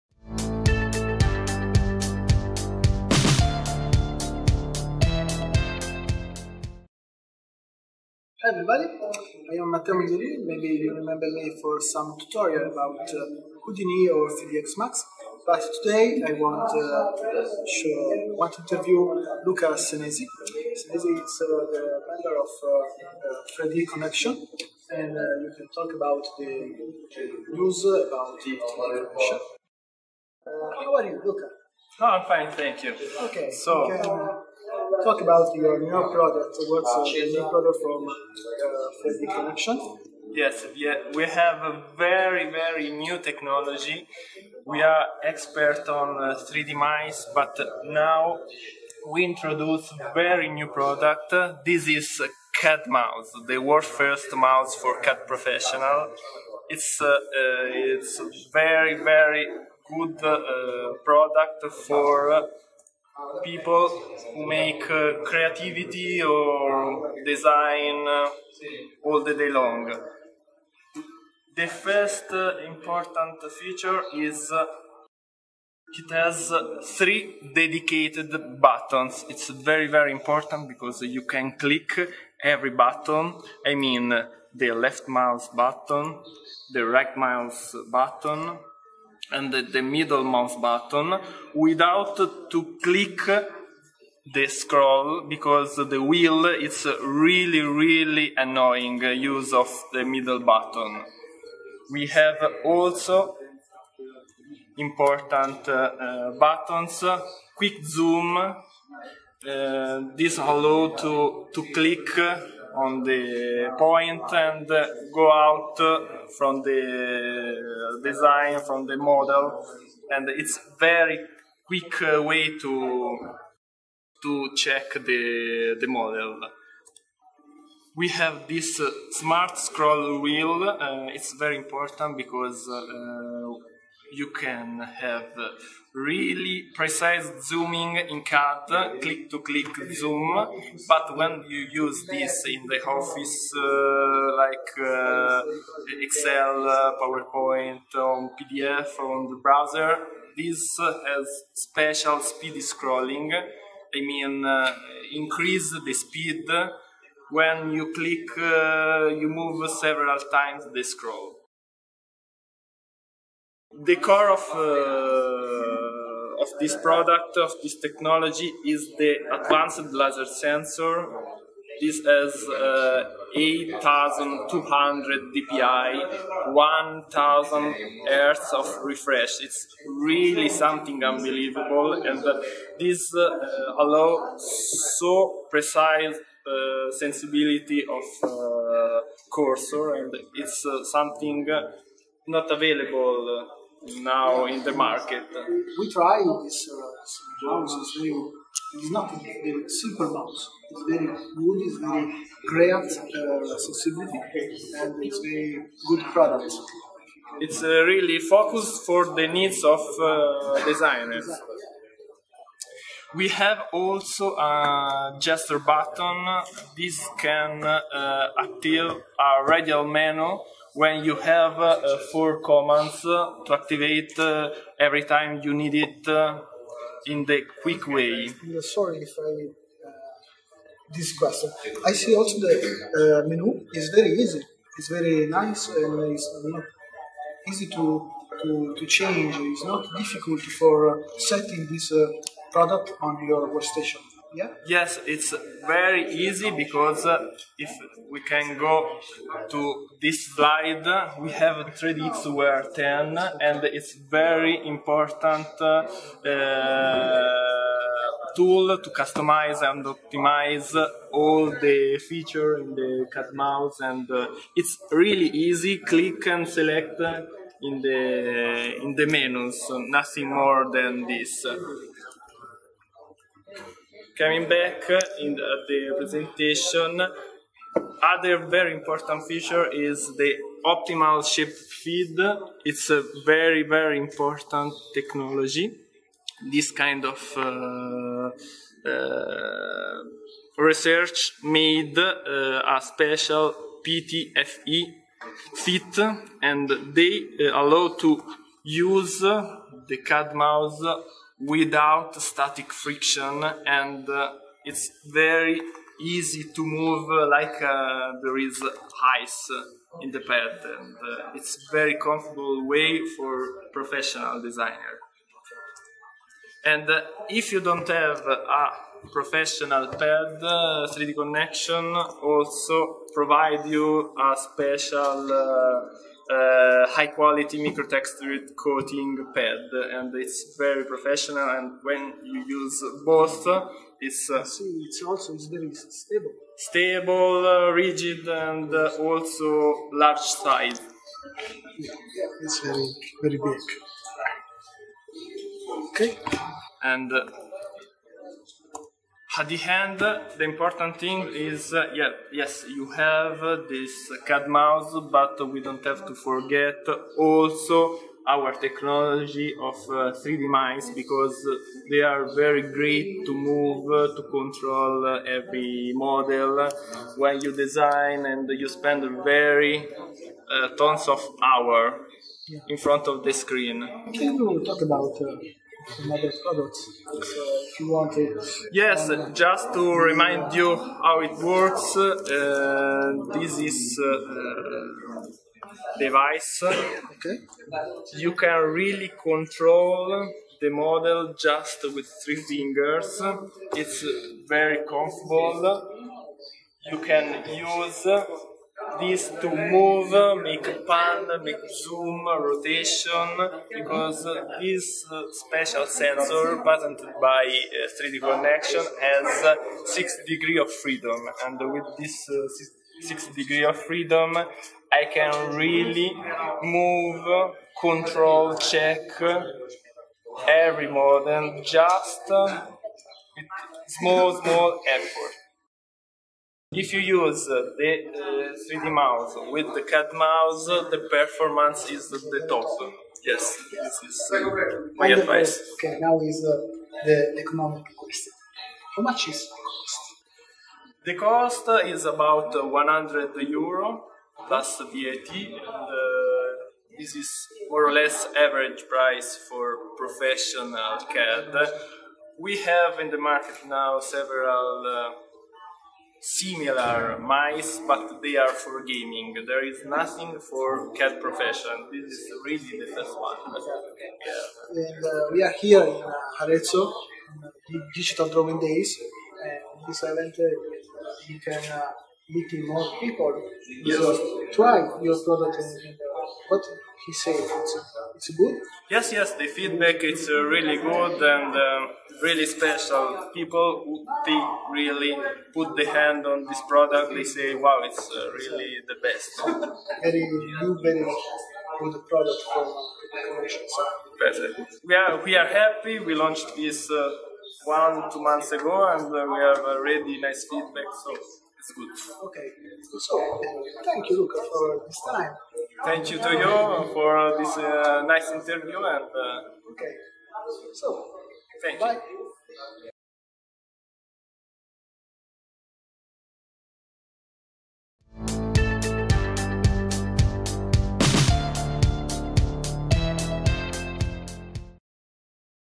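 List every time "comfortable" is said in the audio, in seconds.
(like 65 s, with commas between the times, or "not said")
311 s, 394 s.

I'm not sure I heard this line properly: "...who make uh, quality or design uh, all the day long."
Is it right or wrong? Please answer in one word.
wrong.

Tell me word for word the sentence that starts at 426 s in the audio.
If you use uh, the 3D uh, mouse with the CAD mouse, uh, the performance is the top.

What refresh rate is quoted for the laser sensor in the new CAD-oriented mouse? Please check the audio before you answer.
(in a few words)
1,000 hertz.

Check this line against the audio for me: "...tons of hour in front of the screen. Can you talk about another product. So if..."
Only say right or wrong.
right.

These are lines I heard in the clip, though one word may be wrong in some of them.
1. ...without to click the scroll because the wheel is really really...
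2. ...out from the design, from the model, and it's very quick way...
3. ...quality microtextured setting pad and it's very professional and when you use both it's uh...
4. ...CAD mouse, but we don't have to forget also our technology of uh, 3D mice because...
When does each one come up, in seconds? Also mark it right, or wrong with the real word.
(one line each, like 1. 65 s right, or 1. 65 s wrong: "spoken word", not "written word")
1. 91 s right
2. 115 s right
3. 327 s wrong: "coating", not "setting"
4. 354 s right.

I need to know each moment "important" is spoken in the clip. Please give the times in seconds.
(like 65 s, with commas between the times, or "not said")
72 s, 80 s, 104 s, 131 s, 254 s, 278 s, 283 s, 350 s.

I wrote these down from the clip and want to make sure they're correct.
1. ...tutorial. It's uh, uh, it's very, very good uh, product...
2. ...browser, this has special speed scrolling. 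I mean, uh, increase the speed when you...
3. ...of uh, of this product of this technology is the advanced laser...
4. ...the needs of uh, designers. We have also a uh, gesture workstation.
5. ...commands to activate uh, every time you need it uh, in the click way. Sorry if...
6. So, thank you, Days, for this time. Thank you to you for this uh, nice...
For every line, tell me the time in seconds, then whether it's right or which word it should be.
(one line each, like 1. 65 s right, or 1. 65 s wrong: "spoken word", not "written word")
1. 55 s wrong: "professional", not "tutorial"
2. 149 s right
3. 164 s right
4. 209 s wrong: "button", not "workstation"
5. 222 s wrong: "quick", not "click"
6. 502 s wrong: "Luca", not "Days".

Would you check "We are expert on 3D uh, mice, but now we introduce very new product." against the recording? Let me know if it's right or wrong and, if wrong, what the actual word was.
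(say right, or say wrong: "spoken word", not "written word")
right.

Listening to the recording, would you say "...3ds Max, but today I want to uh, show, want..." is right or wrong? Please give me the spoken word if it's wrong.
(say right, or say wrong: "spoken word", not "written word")
right.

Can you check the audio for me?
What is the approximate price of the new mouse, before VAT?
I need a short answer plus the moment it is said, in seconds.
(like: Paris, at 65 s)
100 euro, at 442 s.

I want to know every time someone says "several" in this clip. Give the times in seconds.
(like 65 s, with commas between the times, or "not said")
159 s, 453 s.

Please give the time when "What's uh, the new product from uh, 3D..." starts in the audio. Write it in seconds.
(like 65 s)
36 s.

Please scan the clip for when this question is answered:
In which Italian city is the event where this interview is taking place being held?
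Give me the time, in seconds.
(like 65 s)
466 s.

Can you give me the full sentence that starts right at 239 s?
It's not difficult for setting this product on your workstation.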